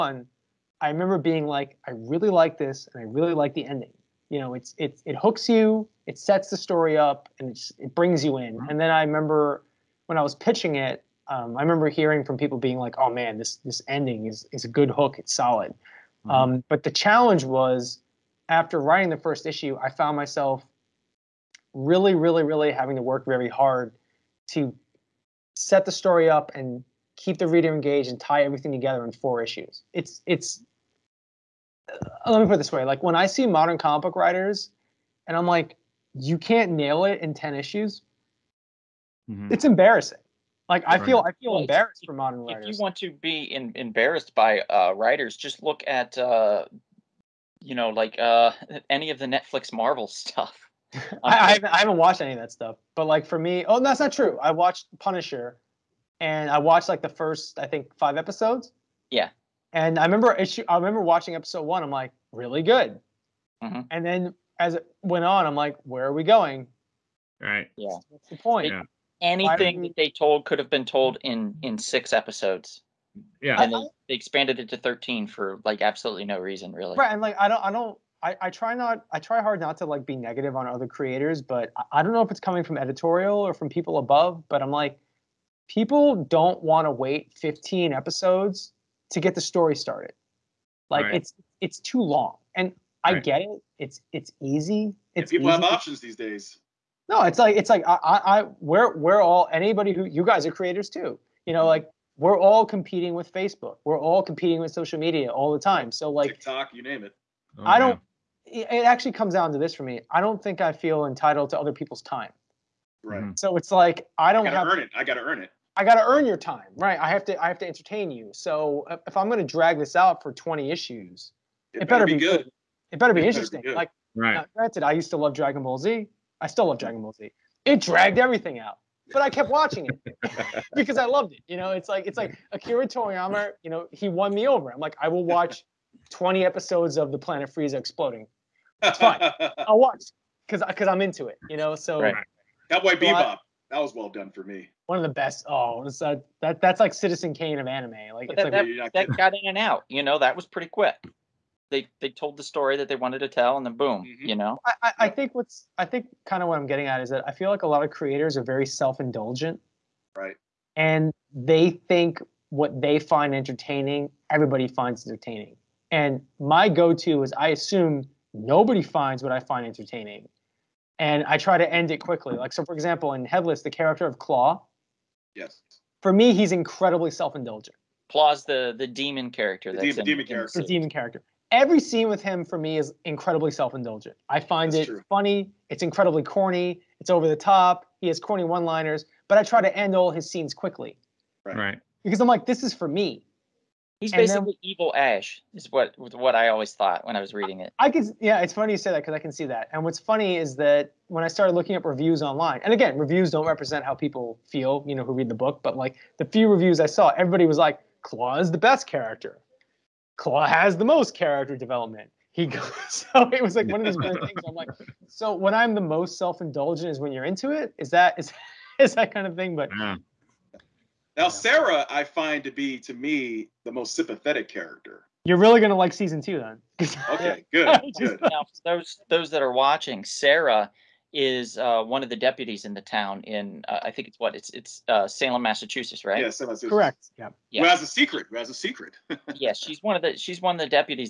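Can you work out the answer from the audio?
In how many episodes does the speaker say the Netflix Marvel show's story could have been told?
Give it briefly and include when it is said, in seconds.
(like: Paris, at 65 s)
6, at 71 s.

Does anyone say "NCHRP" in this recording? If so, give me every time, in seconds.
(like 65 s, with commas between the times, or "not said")
not said.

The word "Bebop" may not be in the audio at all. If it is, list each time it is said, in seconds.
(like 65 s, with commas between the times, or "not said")
142 s.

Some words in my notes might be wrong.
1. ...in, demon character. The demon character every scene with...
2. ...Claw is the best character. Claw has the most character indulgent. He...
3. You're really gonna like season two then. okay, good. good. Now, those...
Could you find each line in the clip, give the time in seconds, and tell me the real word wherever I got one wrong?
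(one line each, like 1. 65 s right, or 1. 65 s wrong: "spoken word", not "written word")
1. 179 s right
2. 208 s wrong: "development", not "indulgent"
3. 225 s right.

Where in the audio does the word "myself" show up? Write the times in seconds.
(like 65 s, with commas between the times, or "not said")
20 s.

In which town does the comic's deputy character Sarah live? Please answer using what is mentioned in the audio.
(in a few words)
Salem, Massachusetts.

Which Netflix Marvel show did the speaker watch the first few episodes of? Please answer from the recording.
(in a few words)
Punisher.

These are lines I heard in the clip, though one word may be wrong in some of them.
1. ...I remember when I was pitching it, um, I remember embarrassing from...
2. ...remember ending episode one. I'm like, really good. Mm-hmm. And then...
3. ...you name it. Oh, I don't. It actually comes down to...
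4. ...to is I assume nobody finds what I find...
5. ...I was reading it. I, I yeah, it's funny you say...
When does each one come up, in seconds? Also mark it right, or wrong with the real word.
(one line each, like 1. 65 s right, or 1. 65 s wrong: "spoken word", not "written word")
1. 8 s wrong: "hearing", not "embarrassing"
2. 60 s wrong: "watching", not "ending"
3. 106 s right
4. 166 s right
5. 197 s right.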